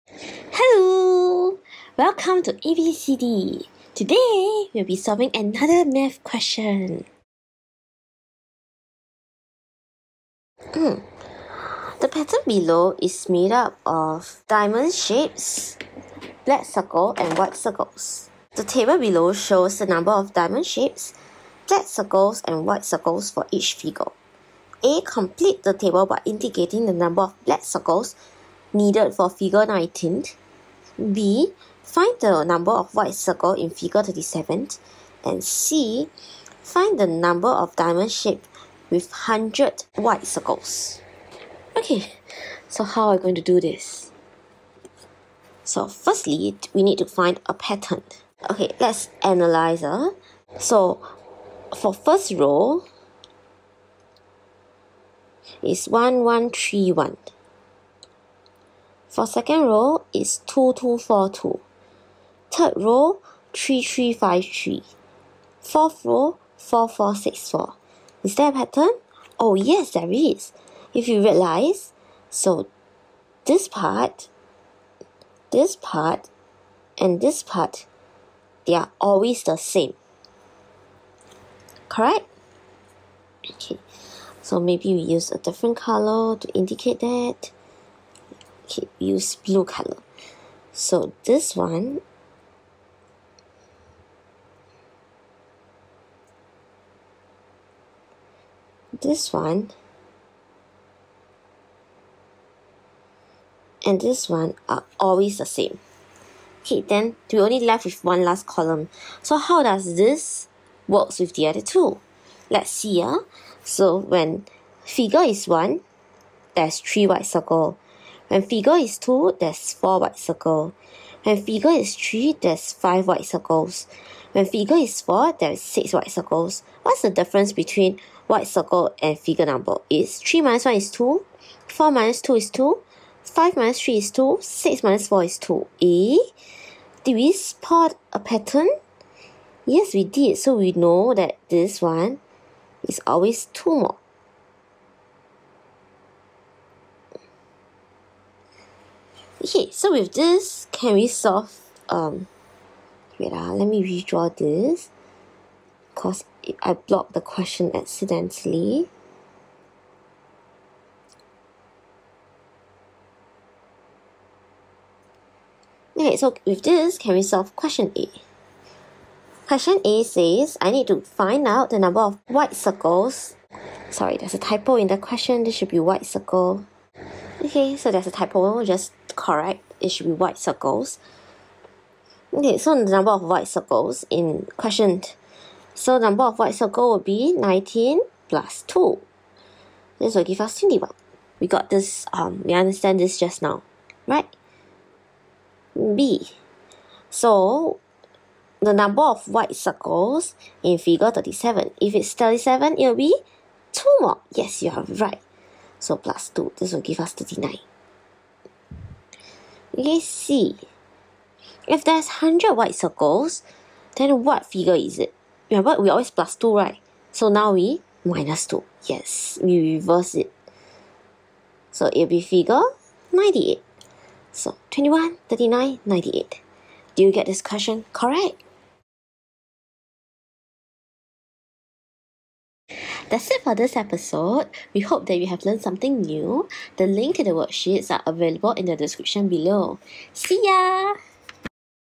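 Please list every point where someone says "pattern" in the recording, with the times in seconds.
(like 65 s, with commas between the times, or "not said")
12 s, 47 s, 68 s, 138 s.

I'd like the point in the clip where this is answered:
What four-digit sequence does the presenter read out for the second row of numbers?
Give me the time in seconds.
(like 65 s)
60 s.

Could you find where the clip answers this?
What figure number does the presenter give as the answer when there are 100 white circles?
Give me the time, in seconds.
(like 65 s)
222 s.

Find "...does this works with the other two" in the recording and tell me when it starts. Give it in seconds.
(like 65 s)
109 s.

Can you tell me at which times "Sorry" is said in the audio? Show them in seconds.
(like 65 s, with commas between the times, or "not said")
173 s.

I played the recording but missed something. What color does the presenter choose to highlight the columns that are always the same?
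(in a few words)
Blue.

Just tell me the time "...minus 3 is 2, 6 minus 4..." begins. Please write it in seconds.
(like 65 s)
133 s.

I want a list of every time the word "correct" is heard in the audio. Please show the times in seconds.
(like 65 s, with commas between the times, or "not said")
81 s, 179 s, 227 s.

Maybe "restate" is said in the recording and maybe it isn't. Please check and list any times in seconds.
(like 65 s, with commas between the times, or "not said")
not said.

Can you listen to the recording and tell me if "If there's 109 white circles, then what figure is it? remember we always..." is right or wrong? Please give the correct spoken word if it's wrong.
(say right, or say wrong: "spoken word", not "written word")
wrong: "100", not "109".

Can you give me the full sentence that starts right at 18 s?
The table below shows the number of diamond shapes, black circles and white circles for each figure.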